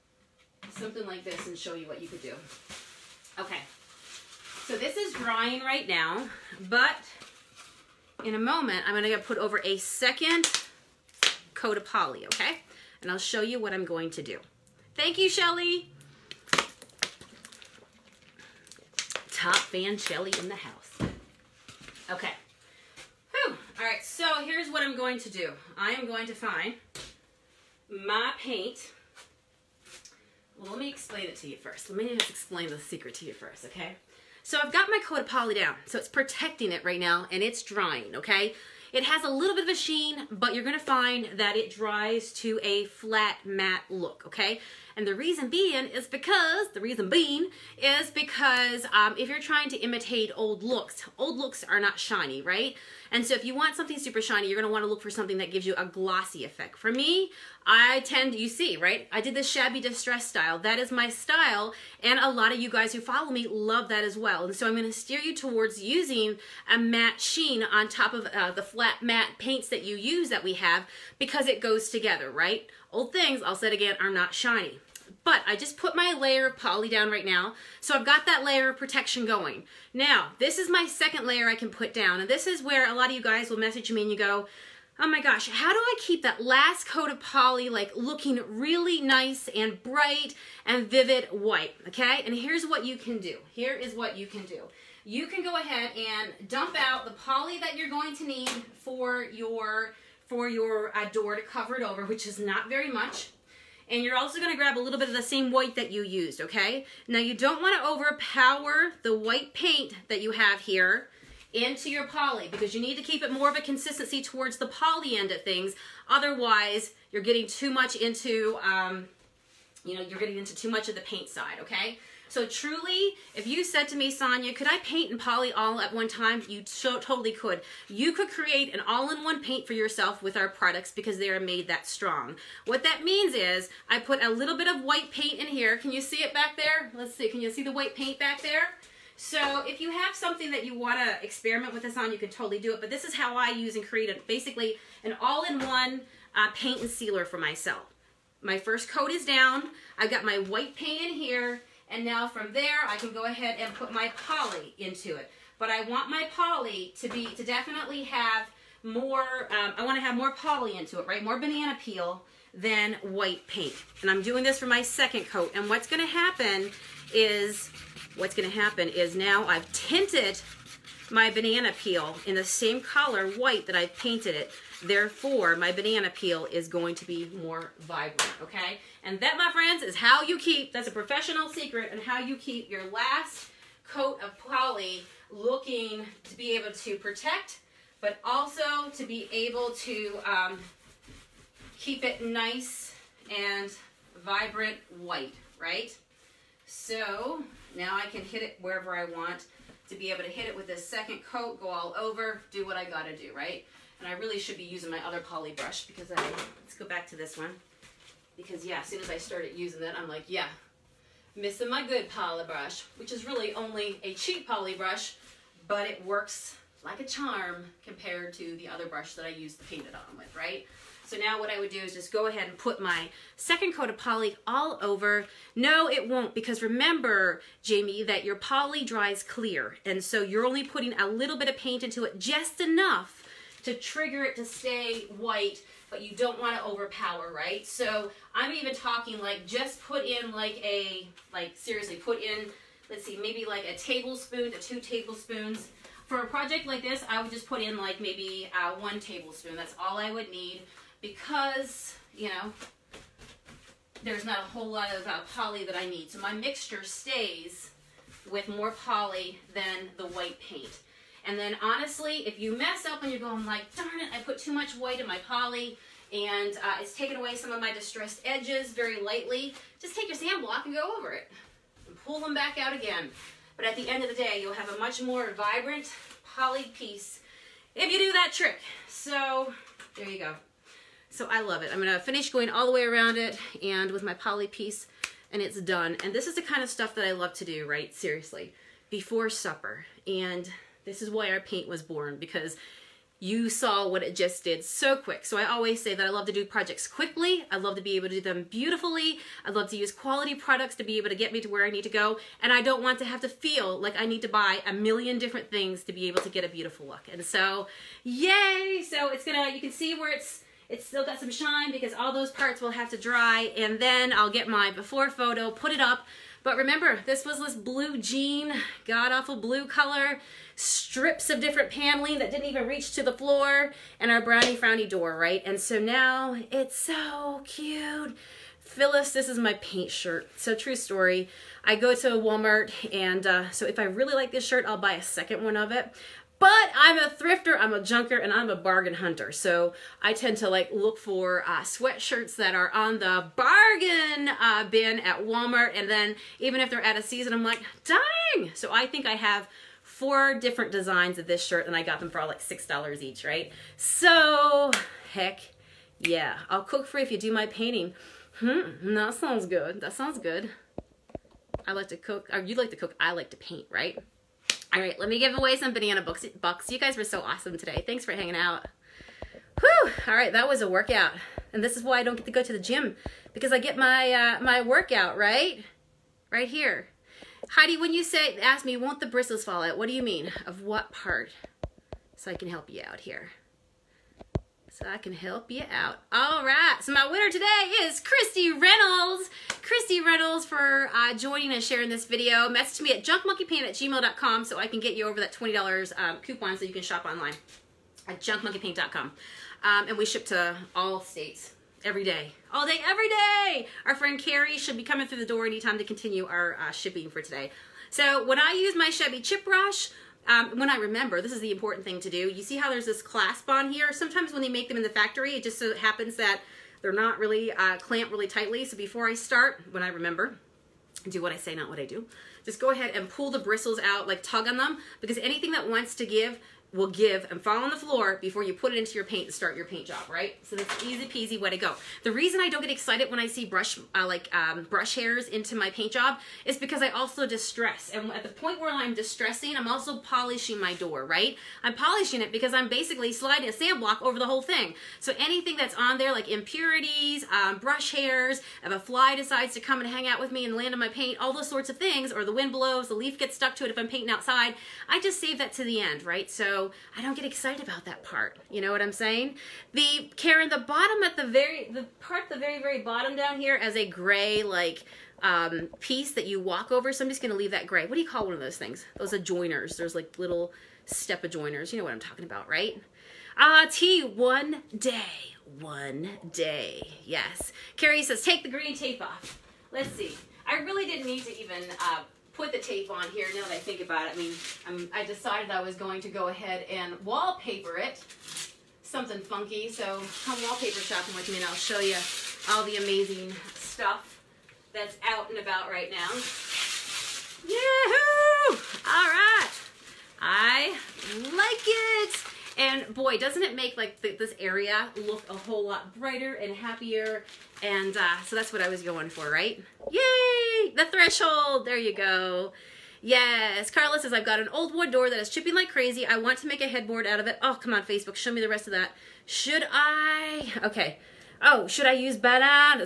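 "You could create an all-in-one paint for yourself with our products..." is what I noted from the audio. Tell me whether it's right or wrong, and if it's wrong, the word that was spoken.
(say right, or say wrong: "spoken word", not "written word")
right.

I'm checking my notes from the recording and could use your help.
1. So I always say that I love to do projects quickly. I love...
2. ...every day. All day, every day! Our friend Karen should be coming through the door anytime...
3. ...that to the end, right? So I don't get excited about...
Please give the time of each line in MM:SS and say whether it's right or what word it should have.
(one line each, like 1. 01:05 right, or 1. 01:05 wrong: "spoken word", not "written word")
1. 04:55 right
2. 06:41 wrong: "Carrie", not "Karen"
3. 07:35 right.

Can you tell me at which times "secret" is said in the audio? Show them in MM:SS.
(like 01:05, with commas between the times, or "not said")
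00:32, 03:01.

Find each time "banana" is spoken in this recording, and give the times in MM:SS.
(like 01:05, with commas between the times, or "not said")
02:41, 02:51, 02:55, 06:05, 08:42.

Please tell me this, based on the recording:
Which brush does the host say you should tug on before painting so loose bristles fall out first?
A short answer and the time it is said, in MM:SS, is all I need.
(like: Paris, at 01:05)
Shabby Chip Brush, at 06:48.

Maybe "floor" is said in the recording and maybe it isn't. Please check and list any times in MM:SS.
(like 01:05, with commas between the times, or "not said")
05:23, 07:07.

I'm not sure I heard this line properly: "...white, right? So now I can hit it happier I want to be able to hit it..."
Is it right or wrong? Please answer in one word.
wrong.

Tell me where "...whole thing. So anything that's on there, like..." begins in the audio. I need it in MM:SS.
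07:24.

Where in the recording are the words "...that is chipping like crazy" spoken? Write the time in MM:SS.
08:35.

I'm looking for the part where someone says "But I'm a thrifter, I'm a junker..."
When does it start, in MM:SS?
05:36.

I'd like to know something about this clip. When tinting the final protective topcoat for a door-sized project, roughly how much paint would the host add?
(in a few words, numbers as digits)
1 tablespoon.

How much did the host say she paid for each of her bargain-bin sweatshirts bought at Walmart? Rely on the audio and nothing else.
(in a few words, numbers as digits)
$6.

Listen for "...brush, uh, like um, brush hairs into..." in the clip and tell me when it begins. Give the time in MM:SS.
07:13.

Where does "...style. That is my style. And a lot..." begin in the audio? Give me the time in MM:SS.
01:00.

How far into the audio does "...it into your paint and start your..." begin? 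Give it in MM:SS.
07:08.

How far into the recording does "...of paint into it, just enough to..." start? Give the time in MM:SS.
03:51.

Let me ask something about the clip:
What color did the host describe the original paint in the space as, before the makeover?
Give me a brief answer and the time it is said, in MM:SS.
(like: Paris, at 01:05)
blue jean, at 05:17.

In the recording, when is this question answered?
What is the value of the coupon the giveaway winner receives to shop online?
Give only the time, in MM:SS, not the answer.
06:35.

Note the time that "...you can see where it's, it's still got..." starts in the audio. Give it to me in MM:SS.
05:09.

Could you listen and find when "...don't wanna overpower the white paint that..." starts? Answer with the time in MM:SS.
01:47.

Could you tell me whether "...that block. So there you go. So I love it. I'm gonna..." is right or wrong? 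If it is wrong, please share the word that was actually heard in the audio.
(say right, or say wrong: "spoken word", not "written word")
wrong: "trick", not "block".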